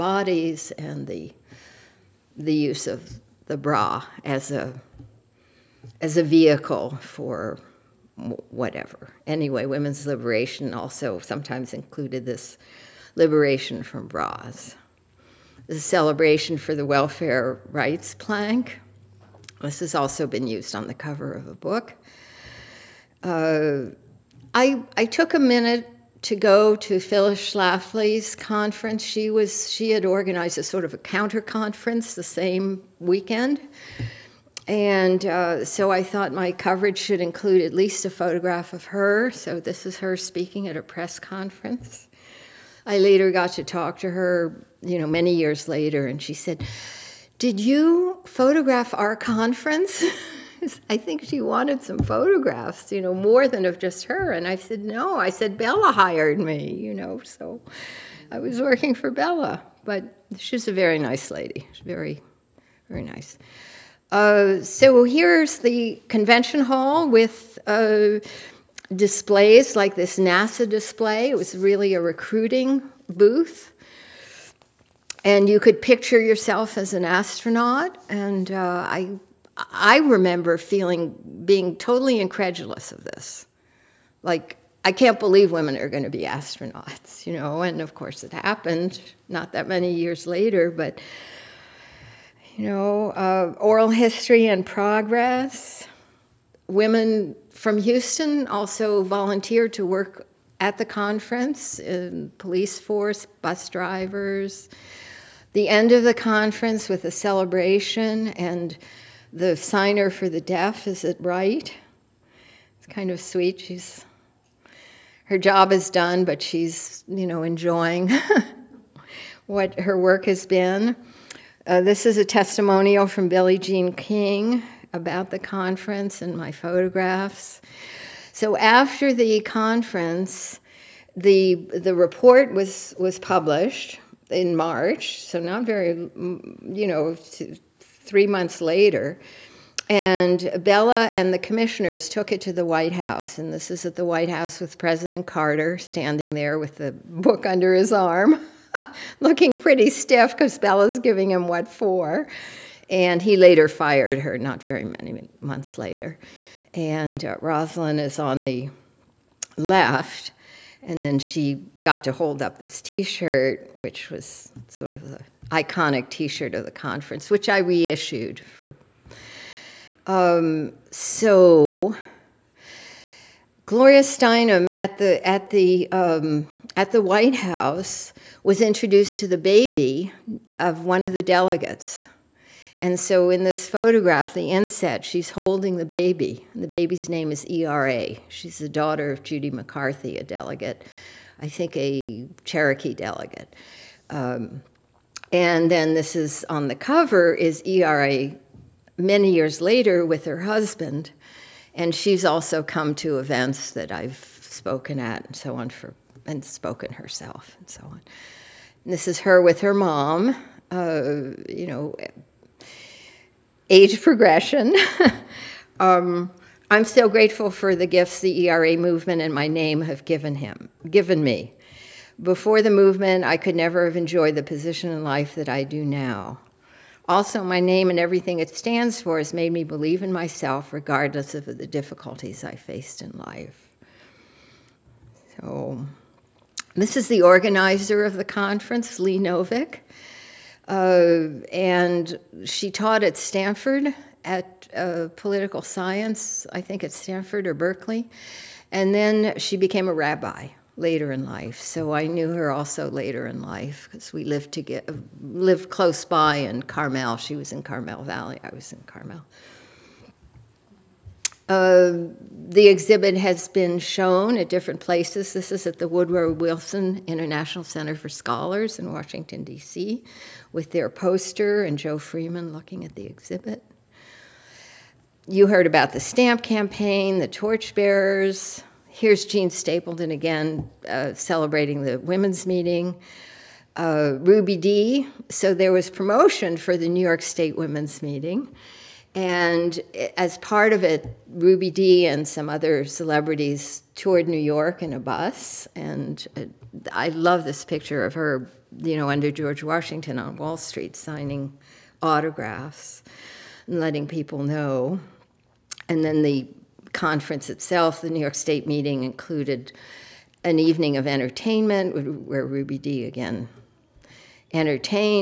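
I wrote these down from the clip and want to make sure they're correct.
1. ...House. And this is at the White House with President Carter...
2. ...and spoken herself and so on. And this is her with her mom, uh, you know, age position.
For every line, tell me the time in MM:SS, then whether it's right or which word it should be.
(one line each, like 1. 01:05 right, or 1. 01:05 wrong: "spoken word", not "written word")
1. 02:22 right
2. 03:26 wrong: "progression", not "position".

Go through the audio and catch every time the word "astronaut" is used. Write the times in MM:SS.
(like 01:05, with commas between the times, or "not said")
01:17, 01:26.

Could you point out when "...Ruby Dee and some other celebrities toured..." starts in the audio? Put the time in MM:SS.
04:51.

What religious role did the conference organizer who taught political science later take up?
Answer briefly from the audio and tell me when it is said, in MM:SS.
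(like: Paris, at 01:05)
Rabbi, at 04:09.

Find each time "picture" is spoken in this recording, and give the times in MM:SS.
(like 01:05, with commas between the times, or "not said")
01:15, 04:57.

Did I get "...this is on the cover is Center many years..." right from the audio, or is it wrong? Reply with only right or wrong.
wrong.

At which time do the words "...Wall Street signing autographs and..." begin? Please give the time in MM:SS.
05:00.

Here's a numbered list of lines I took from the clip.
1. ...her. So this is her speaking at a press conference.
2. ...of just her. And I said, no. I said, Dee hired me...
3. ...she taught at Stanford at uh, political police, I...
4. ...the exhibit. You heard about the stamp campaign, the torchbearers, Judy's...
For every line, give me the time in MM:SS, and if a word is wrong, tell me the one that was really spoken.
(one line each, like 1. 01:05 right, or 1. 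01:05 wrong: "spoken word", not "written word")
1. 00:38 right
2. 00:53 wrong: "Bella", not "Dee"
3. 04:02 wrong: "science", not "police"
4. 04:32 wrong: "Here", not "Judy".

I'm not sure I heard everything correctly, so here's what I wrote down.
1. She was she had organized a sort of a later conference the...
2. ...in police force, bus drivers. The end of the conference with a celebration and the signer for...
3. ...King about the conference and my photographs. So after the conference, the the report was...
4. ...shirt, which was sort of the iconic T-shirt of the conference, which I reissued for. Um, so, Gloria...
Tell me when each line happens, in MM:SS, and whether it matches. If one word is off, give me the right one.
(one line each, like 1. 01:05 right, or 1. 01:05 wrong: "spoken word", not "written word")
1. 00:29 wrong: "counter", not "later"
2. 01:41 right
3. 02:03 right
4. 02:43 right.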